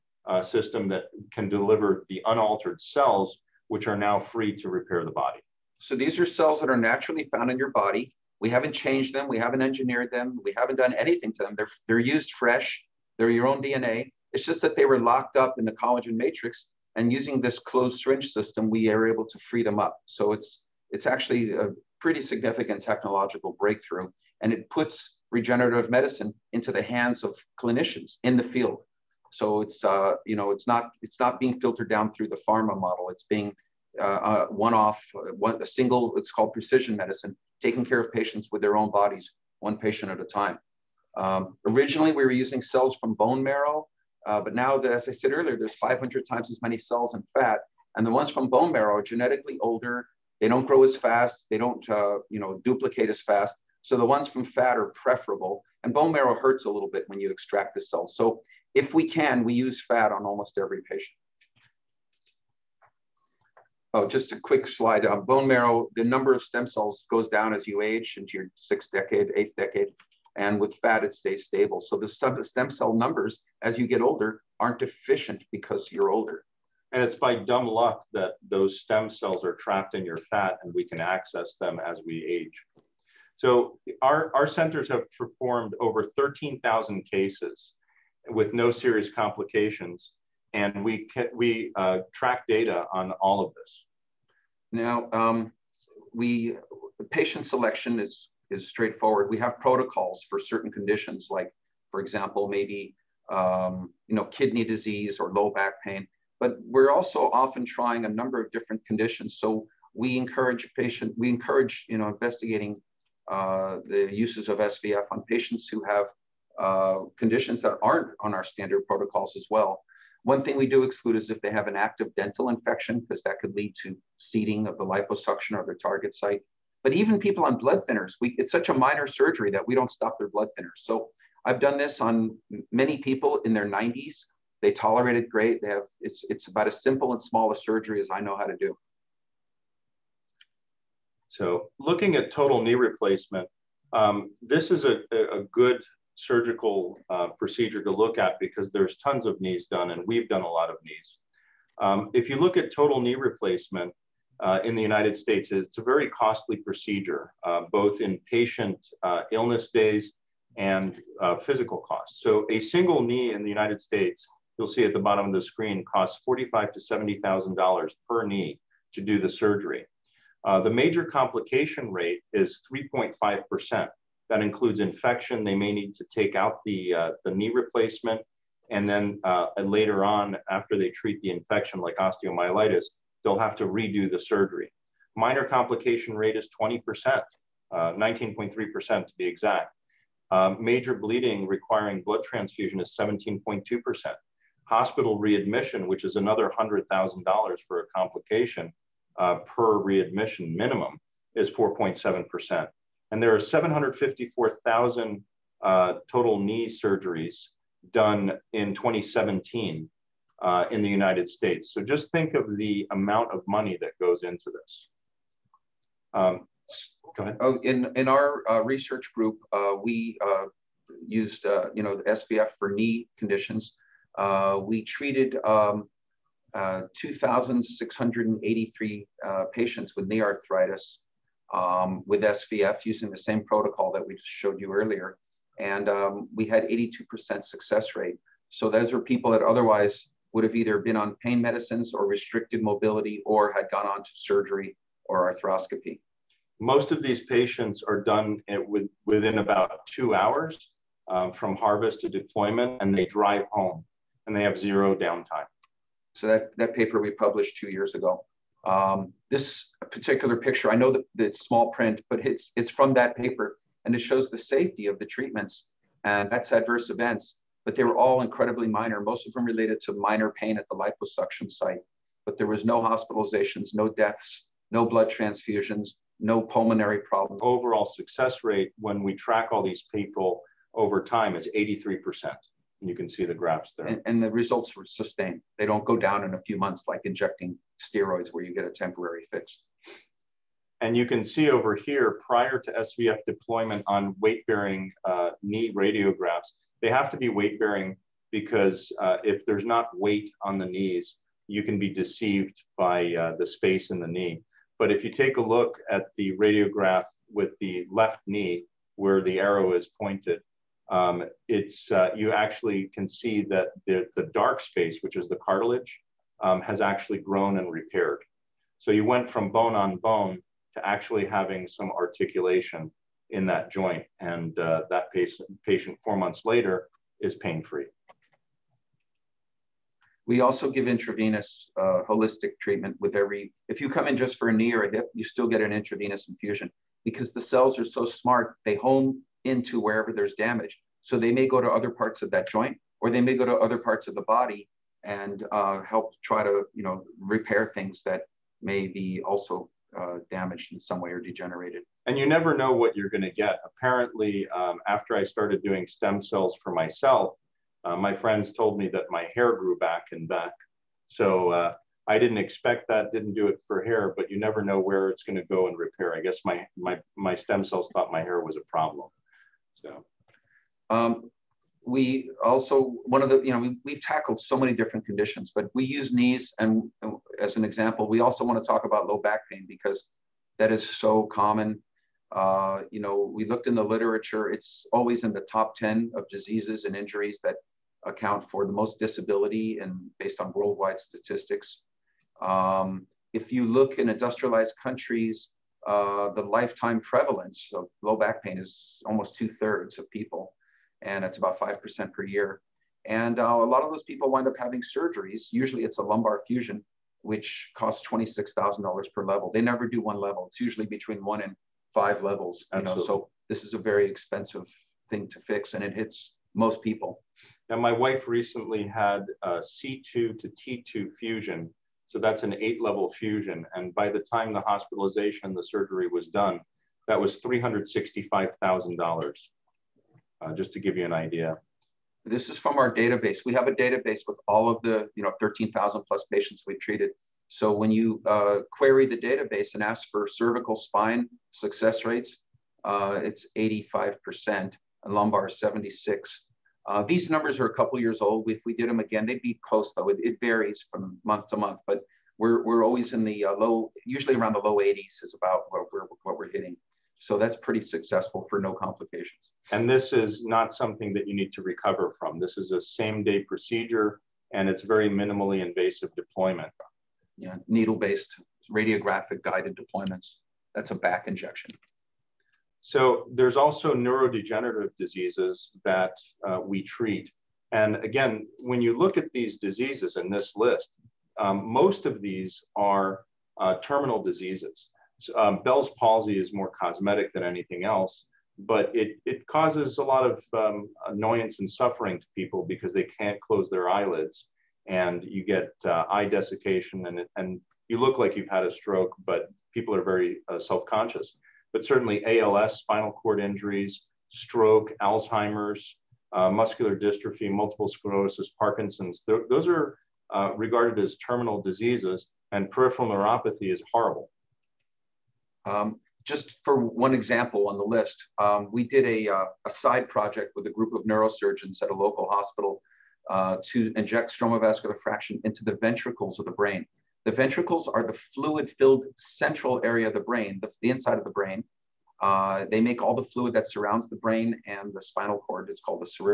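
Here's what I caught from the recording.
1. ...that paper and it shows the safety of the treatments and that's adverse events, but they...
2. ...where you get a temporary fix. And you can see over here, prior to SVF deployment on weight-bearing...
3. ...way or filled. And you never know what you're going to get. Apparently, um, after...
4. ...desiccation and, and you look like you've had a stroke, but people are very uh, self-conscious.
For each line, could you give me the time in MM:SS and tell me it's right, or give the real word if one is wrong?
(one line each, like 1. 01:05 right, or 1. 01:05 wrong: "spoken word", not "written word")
1. 04:22 right
2. 04:48 right
3. 05:51 wrong: "degenerated", not "filled"
4. 08:16 right.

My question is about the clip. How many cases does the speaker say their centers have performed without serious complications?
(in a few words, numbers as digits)
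13,000.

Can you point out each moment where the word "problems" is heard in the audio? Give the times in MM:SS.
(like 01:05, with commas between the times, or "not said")
04:37, 06:08.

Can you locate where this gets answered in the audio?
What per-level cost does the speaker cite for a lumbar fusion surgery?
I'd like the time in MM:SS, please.
06:48.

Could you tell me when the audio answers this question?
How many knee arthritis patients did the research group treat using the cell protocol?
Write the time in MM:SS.
03:46.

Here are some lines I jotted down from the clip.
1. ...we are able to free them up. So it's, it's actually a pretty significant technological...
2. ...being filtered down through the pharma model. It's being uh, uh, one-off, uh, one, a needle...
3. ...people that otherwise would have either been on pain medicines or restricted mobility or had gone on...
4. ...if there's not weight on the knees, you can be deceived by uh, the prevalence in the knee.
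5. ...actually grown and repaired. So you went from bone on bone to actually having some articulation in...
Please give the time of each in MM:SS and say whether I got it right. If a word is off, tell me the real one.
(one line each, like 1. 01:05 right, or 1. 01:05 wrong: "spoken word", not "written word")
1. 00:18 right
2. 00:31 wrong: "single", not "needle"
3. 03:59 right
4. 04:59 wrong: "space", not "prevalence"
5. 05:16 right.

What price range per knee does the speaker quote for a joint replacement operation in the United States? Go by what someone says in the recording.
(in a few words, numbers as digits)
$45,000 to $70,000.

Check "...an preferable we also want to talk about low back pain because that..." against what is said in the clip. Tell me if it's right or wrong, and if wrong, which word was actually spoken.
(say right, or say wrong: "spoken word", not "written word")
wrong: "example", not "preferable".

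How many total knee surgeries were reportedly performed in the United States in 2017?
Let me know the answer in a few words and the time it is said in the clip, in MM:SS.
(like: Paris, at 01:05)
754,000, at 03:23.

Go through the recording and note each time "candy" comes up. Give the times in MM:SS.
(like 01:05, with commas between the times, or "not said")
not said.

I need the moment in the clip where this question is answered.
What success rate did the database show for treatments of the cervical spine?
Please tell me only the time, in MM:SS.
07:23.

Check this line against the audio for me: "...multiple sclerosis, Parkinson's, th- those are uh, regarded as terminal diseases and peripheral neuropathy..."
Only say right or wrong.
right.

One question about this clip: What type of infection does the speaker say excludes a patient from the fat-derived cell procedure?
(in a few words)
active dental infection.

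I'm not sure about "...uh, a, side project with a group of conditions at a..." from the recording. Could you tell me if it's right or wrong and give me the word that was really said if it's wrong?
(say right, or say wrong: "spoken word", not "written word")
wrong: "neurosurgeons", not "conditions".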